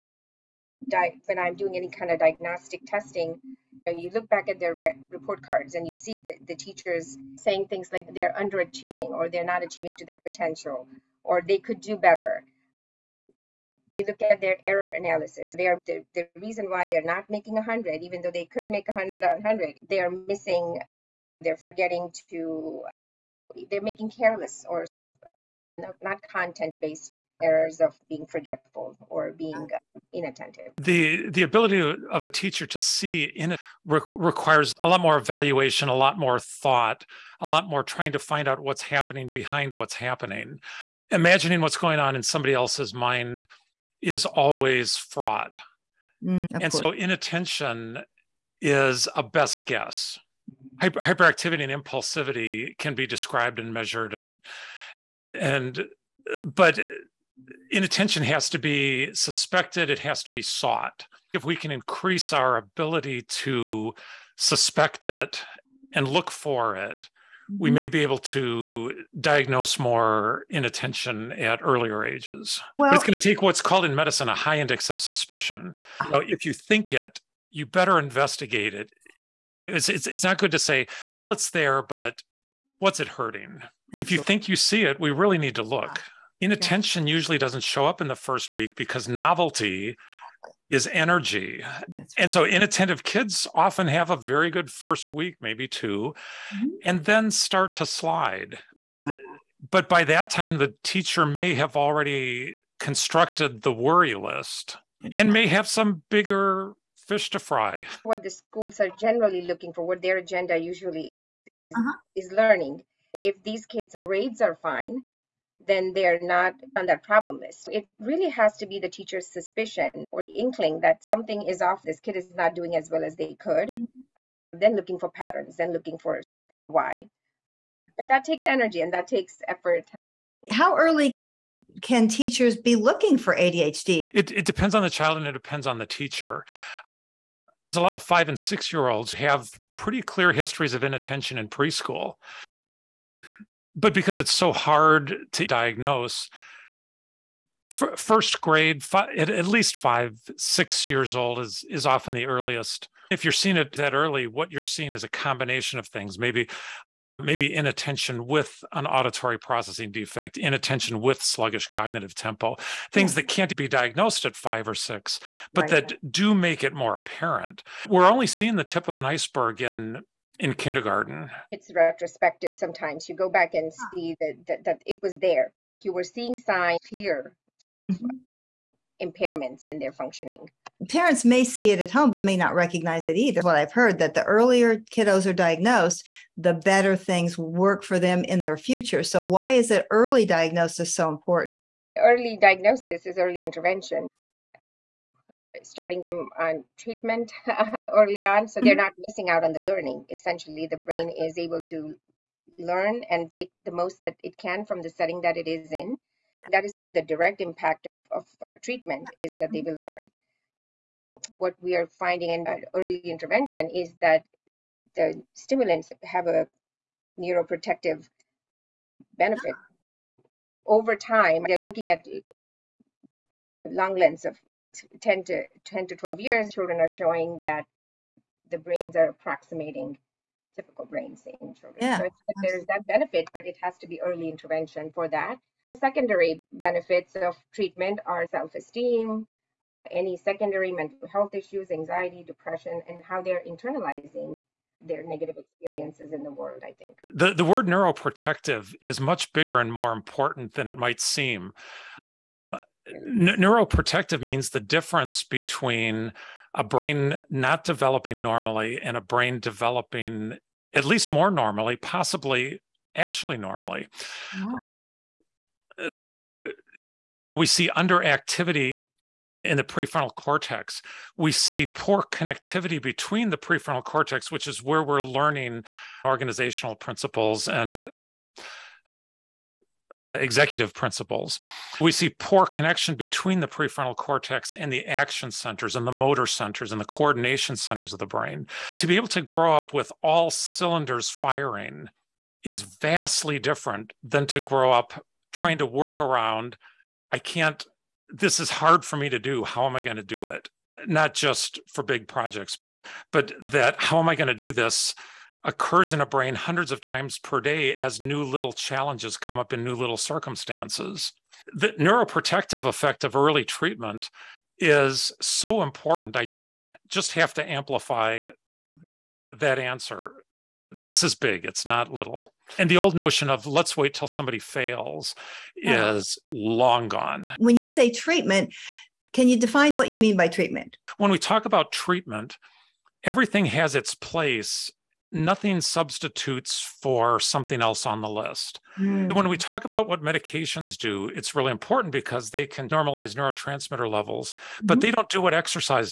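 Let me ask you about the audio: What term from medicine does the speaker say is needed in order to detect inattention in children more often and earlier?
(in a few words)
high index of suspicion.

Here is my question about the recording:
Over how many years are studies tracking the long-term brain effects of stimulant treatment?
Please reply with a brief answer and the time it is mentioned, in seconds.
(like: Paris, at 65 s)
10 to 12 years, at 225 s.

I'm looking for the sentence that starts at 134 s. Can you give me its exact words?
It, it depends on the child and it depends on the teacher.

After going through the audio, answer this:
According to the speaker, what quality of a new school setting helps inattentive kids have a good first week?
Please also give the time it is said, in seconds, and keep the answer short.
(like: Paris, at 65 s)
novelty, at 89 s.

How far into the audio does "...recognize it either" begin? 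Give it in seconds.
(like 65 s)
182 s.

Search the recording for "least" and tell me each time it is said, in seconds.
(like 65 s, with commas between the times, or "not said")
149 s, 260 s.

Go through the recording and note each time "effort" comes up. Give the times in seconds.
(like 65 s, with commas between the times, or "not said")
129 s.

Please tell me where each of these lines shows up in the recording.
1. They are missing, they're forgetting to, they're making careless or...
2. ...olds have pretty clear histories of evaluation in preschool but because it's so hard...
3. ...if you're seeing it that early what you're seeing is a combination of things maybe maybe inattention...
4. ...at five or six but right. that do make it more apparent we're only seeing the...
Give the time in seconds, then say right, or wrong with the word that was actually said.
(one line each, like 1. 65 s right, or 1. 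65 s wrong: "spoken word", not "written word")
1. 19 s right
2. 138 s wrong: "inattention", not "evaluation"
3. 153 s right
4. 164 s right.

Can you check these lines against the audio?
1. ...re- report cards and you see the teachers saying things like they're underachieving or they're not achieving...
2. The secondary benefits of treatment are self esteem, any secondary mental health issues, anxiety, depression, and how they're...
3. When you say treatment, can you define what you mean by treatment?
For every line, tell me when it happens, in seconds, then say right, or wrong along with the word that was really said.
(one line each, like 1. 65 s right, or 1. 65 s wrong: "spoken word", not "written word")
1. 4 s right
2. 235 s right
3. 327 s right.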